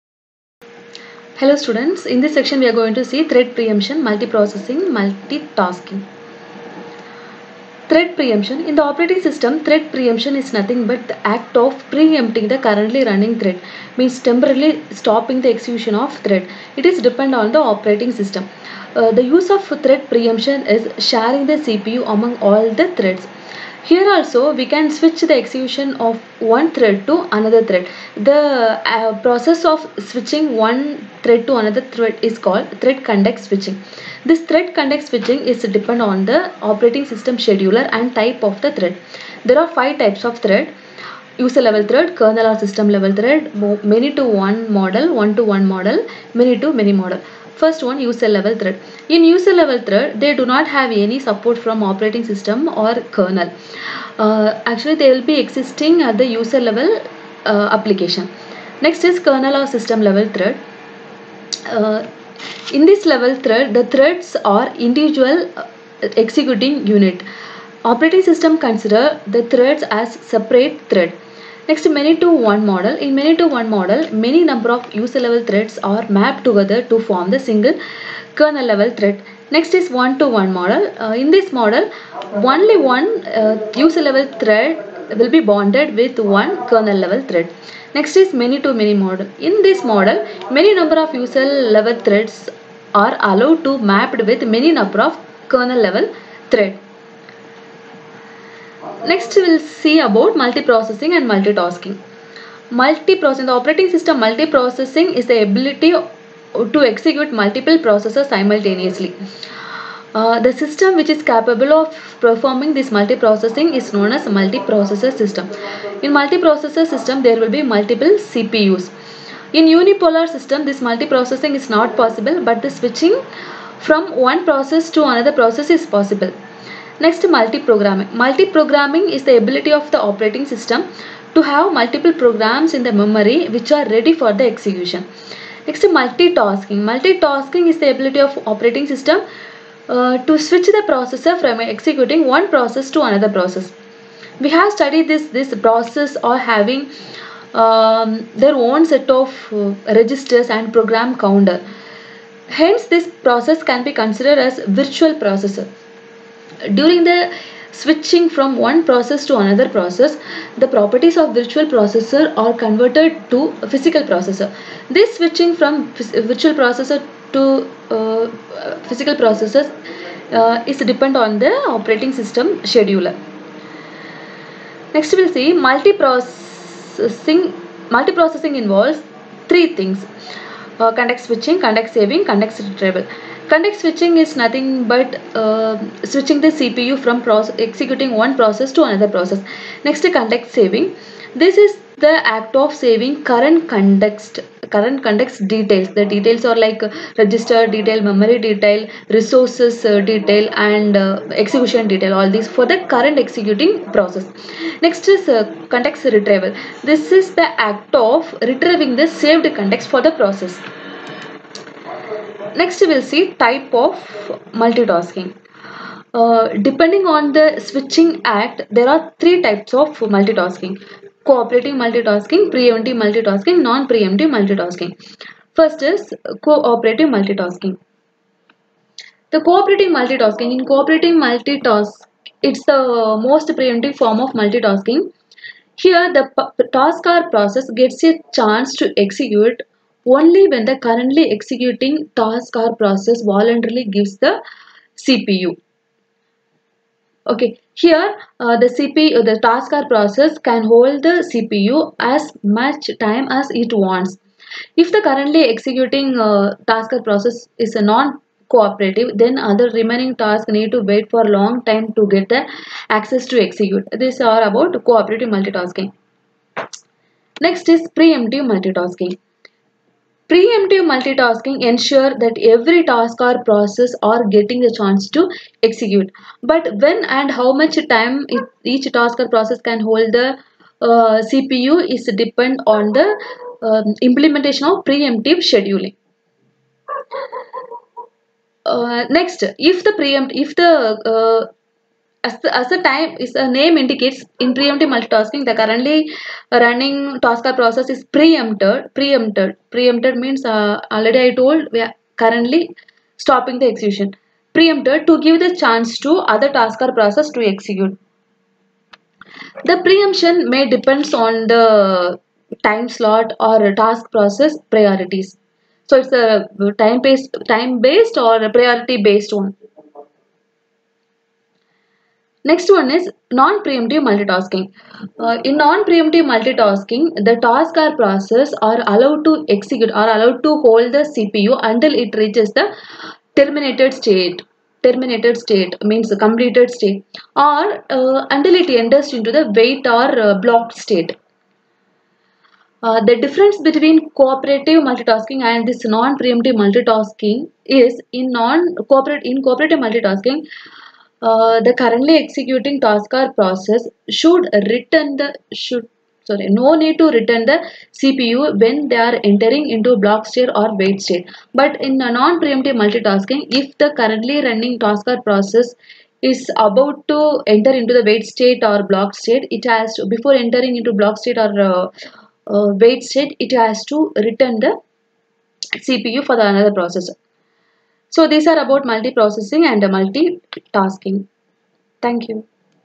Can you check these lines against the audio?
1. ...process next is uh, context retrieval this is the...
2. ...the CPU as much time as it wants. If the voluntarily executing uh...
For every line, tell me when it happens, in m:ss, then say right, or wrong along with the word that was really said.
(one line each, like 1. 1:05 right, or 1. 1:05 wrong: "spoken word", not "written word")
1. 3:23 right
2. 4:11 wrong: "currently", not "voluntarily".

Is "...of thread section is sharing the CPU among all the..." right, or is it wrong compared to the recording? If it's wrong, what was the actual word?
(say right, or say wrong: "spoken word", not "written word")
wrong: "preemption", not "section".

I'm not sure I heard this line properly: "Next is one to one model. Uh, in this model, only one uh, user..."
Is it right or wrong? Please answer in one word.
right.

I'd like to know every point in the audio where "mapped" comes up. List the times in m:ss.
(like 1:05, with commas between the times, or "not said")
1:16, 1:33.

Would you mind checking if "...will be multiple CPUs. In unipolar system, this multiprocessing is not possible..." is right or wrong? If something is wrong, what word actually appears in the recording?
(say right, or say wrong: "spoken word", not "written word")
right.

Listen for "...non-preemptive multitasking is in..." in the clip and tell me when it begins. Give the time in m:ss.
5:45.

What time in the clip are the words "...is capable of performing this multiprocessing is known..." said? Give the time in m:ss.
1:51.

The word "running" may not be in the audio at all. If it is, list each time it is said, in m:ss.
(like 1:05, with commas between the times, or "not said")
0:13, 4:56, 6:04.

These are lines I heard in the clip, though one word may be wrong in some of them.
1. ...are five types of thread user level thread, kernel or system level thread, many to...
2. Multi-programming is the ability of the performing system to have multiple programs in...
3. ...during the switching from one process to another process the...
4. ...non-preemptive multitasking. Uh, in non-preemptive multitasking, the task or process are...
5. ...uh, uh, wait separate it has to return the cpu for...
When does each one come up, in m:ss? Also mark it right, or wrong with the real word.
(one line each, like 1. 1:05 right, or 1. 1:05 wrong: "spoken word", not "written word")
1. 0:39 right
2. 2:08 wrong: "operating", not "performing"
3. 2:36 right
4. 5:23 right
5. 6:11 wrong: "state", not "separate".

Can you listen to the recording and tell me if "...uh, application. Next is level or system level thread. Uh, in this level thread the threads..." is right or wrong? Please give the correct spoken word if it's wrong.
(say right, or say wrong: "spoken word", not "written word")
wrong: "kernel", not "level".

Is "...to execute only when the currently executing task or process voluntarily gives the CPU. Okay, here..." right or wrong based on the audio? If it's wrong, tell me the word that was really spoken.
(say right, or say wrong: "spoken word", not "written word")
right.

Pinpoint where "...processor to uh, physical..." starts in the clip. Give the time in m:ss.
2:46.